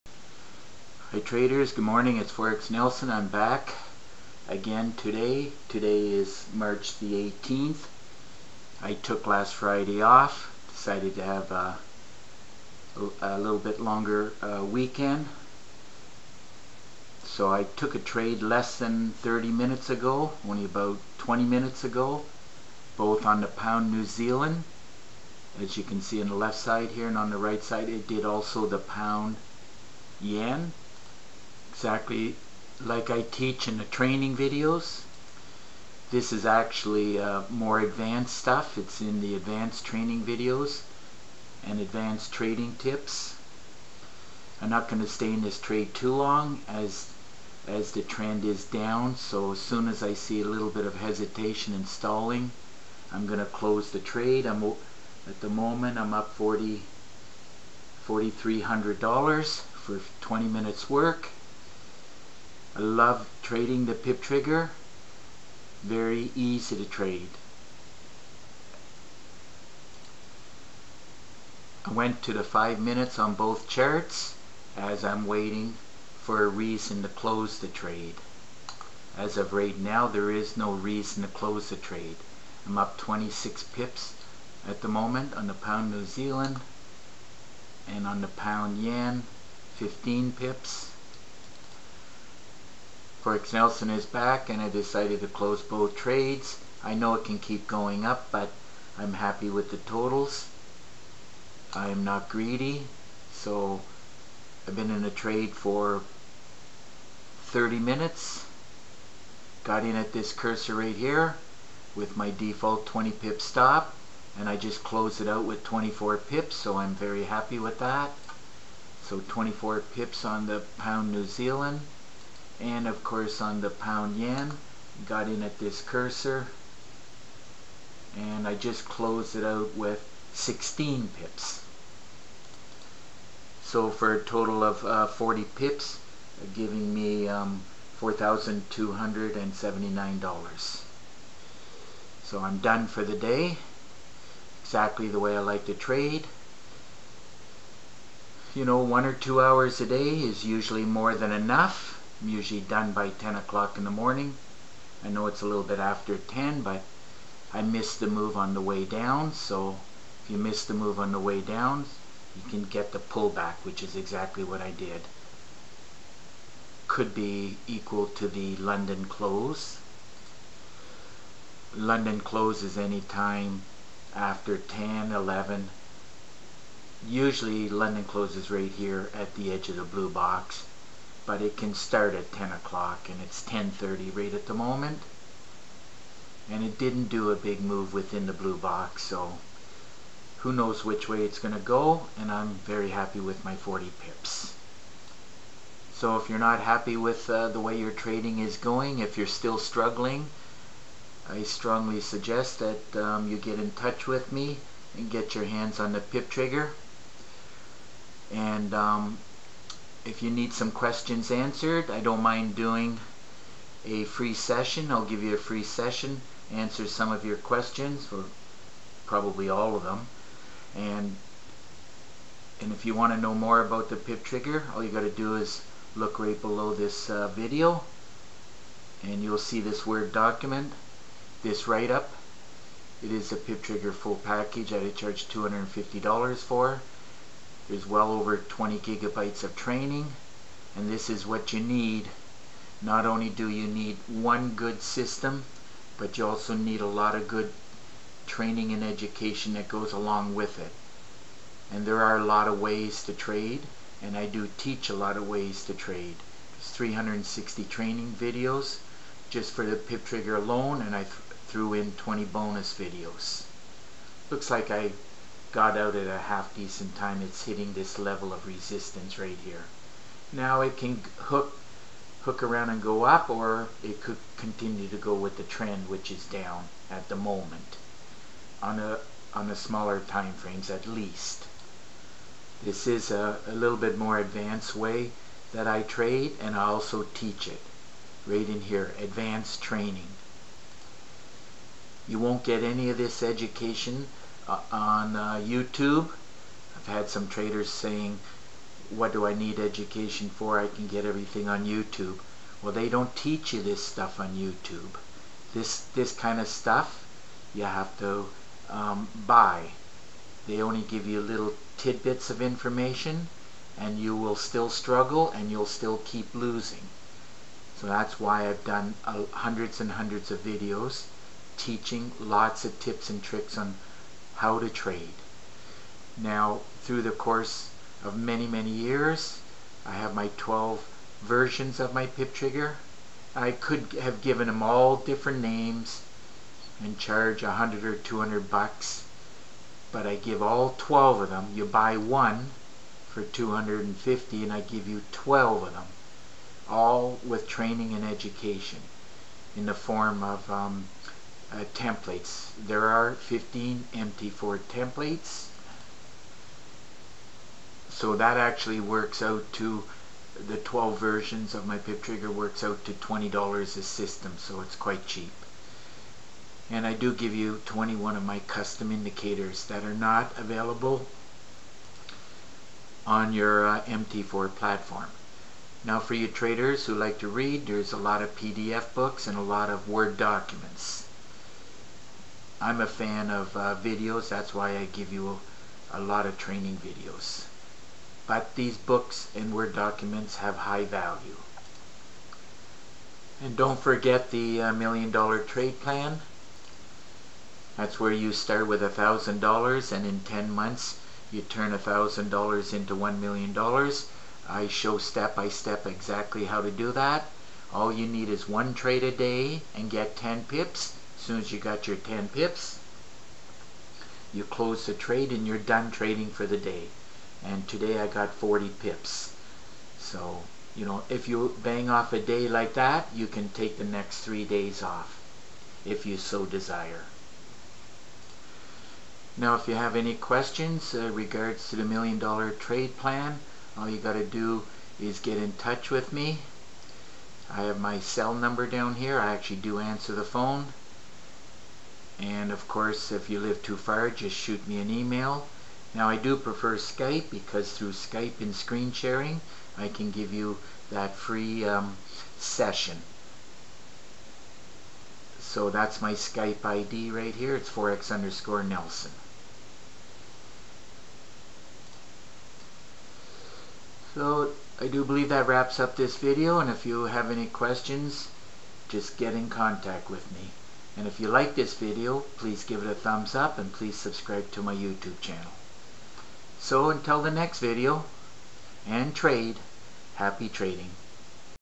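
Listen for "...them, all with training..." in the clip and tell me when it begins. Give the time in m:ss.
5:45.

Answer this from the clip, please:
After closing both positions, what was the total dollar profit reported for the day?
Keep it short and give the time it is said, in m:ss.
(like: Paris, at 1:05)
$4,279, at 2:17.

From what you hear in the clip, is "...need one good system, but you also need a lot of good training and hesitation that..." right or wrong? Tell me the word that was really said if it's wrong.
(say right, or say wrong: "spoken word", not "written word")
wrong: "education", not "hesitation".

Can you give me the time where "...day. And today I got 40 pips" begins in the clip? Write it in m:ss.
6:56.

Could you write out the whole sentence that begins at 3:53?
It is a PIP trigger full package that I charge $250 for.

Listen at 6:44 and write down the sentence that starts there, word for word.
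I show step by step exactly how to do that.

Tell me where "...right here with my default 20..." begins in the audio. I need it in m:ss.
1:50.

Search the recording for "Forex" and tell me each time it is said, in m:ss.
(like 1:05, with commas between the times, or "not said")
0:02, 1:33.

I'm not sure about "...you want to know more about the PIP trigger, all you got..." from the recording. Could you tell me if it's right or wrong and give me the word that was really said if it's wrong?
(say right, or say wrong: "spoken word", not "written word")
right.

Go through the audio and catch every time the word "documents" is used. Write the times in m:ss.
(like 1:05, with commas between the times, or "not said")
3:50, 6:20, 6:29.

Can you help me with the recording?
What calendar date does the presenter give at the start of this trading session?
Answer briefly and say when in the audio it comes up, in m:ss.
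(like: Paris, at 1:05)
March 18, at 0:06.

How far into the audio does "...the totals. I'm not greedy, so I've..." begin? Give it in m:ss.
1:39.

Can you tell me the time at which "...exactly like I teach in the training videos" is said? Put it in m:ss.
0:31.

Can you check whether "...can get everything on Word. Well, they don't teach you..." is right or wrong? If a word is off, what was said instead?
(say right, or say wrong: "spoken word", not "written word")
wrong: "YouTube", not "Word".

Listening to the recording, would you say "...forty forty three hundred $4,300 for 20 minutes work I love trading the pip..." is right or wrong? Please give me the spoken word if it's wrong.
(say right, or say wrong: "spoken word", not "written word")
right.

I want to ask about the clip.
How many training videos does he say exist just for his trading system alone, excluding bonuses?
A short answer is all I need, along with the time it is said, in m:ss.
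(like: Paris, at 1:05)
360, at 4:16.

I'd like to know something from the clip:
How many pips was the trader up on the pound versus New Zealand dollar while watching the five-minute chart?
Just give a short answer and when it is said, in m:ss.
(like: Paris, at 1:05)
26, at 1:22.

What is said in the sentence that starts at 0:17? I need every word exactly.
So I took a trade less than 30 minutes ago, only about 20 minutes ago, both on the pound New Zealand.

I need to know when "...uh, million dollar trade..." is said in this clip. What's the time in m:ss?
6:34.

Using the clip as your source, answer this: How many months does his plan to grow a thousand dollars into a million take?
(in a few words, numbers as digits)
10.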